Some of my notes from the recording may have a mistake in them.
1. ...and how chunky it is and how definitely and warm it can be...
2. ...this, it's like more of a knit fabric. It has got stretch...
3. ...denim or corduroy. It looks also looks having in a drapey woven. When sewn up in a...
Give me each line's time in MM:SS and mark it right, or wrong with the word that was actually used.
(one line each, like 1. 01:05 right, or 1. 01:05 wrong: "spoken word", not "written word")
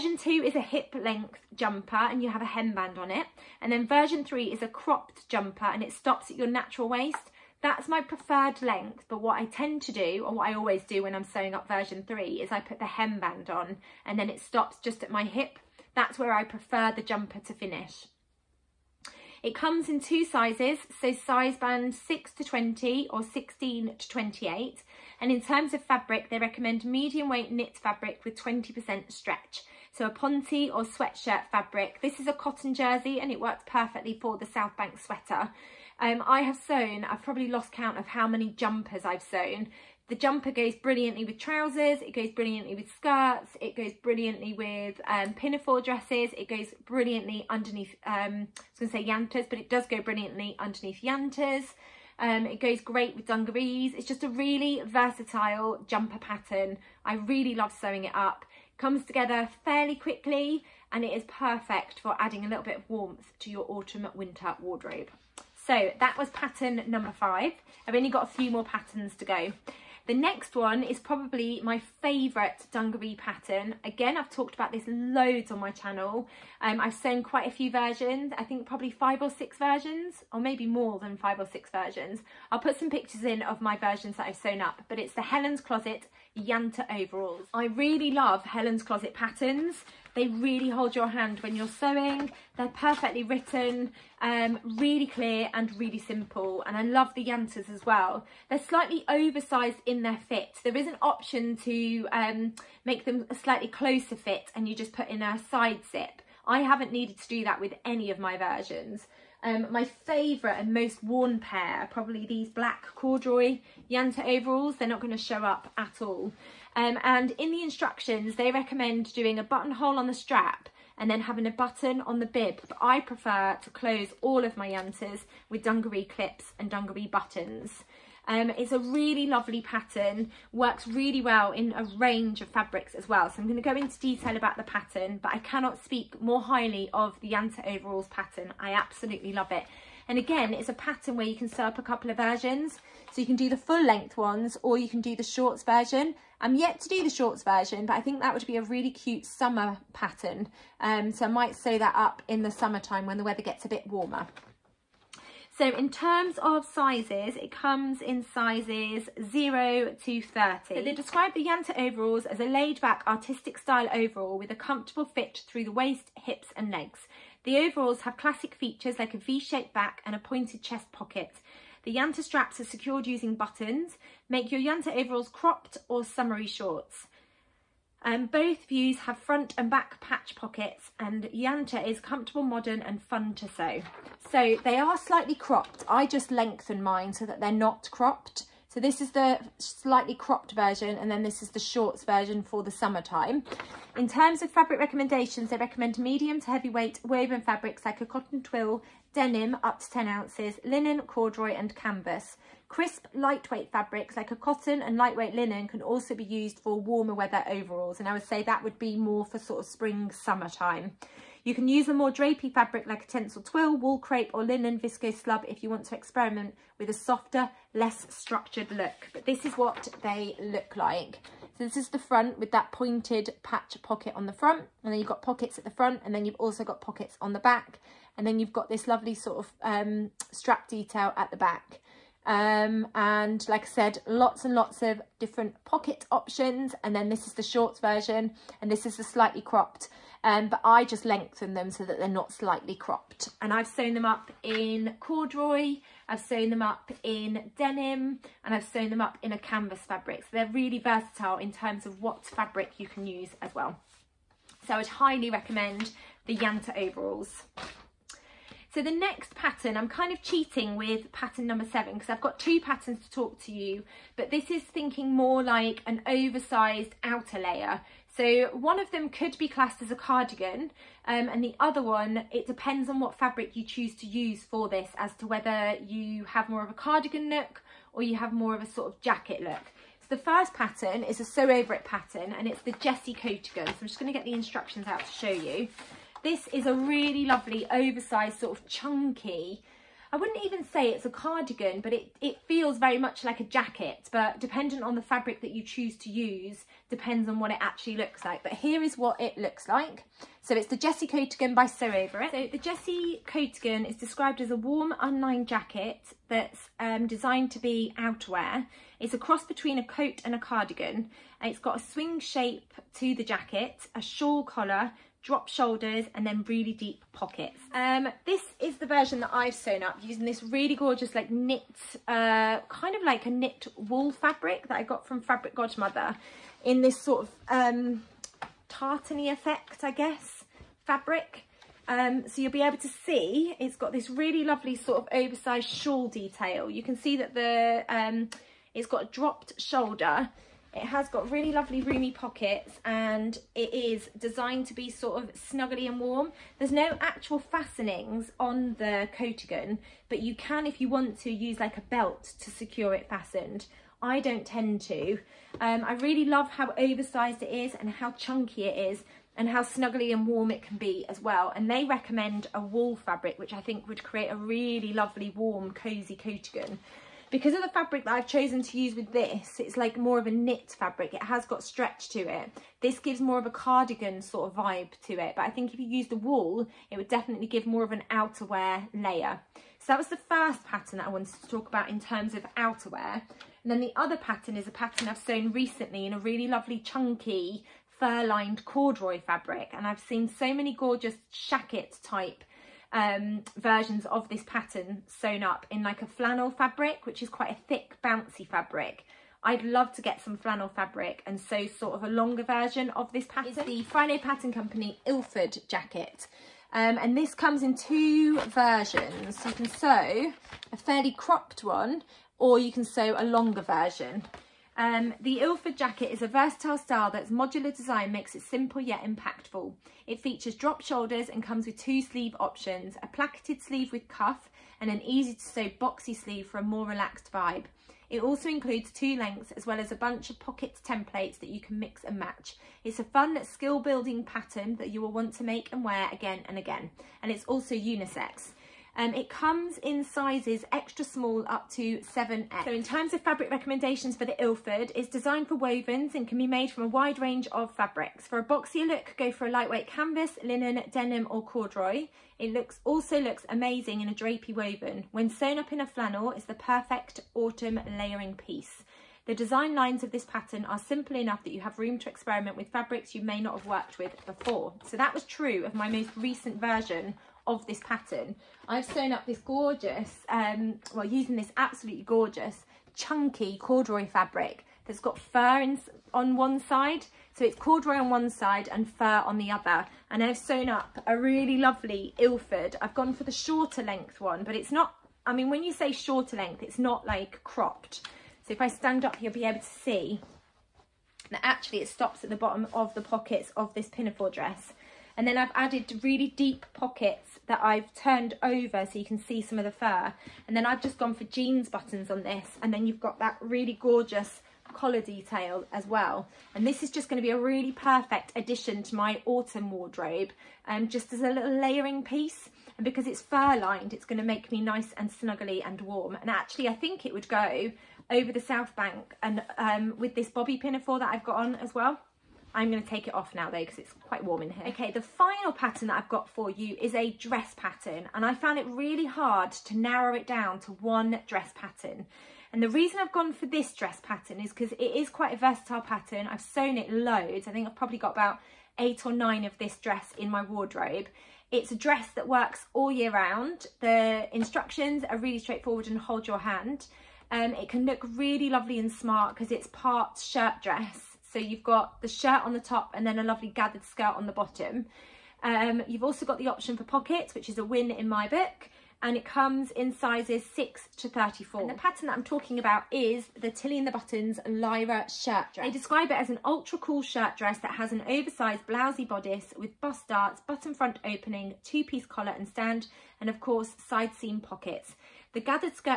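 1. 05:57 wrong: "snuggly", not "definitely"
2. 06:09 right
3. 07:30 wrong: "amazing", not "having".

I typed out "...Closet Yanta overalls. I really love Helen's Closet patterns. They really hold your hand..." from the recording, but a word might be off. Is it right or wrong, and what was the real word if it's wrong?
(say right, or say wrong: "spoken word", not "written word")
right.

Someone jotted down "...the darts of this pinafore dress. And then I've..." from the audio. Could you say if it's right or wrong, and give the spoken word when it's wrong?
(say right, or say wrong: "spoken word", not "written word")
wrong: "pockets", not "darts".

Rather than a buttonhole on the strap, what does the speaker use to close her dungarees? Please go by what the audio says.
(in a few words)
dungaree clips.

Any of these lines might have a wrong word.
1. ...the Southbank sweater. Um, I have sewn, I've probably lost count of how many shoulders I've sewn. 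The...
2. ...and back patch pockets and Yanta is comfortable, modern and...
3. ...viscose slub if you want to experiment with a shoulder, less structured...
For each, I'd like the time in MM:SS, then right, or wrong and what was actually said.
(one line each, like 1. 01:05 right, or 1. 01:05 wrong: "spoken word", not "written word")
1. 00:34 wrong: "jumpers", not "shoulders"
2. 02:59 right
3. 03:34 wrong: "softer", not "shoulder".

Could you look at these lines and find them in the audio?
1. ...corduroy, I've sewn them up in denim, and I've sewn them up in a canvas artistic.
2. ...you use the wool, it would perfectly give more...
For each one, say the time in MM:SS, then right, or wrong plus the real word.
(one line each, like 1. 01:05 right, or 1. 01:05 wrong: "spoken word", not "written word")
1. 04:04 wrong: "fabric", not "artistic"
2. 06:15 wrong: "definitely", not "perfectly".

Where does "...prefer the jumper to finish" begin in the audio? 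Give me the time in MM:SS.
00:16.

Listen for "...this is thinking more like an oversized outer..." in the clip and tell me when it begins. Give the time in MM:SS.
04:24.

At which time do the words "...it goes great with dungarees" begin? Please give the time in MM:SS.
00:52.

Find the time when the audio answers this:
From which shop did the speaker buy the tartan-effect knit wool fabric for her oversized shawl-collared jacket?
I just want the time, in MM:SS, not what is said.
05:25.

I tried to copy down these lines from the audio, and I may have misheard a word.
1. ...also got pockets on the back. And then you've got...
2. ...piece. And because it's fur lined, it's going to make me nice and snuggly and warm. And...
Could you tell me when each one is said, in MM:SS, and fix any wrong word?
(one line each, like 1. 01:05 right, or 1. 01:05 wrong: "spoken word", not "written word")
1. 03:46 right
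2. 08:32 right.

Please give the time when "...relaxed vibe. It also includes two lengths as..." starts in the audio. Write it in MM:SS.
07:06.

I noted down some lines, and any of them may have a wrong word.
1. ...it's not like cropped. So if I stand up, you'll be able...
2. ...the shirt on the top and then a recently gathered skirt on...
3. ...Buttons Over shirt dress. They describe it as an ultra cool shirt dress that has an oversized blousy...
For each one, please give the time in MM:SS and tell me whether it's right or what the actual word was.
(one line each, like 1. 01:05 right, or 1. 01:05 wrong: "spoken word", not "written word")
1. 08:06 right
2. 09:12 wrong: "lovely", not "recently"
3. 09:23 wrong: "Lyra", not "Over".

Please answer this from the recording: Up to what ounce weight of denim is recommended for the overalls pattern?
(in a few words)
10 ounces.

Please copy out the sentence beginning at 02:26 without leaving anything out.
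I'm yet to do the shorts version, but I think that would be a really cute summer pattern.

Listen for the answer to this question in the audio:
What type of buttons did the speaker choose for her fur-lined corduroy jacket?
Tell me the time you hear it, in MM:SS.
08:21.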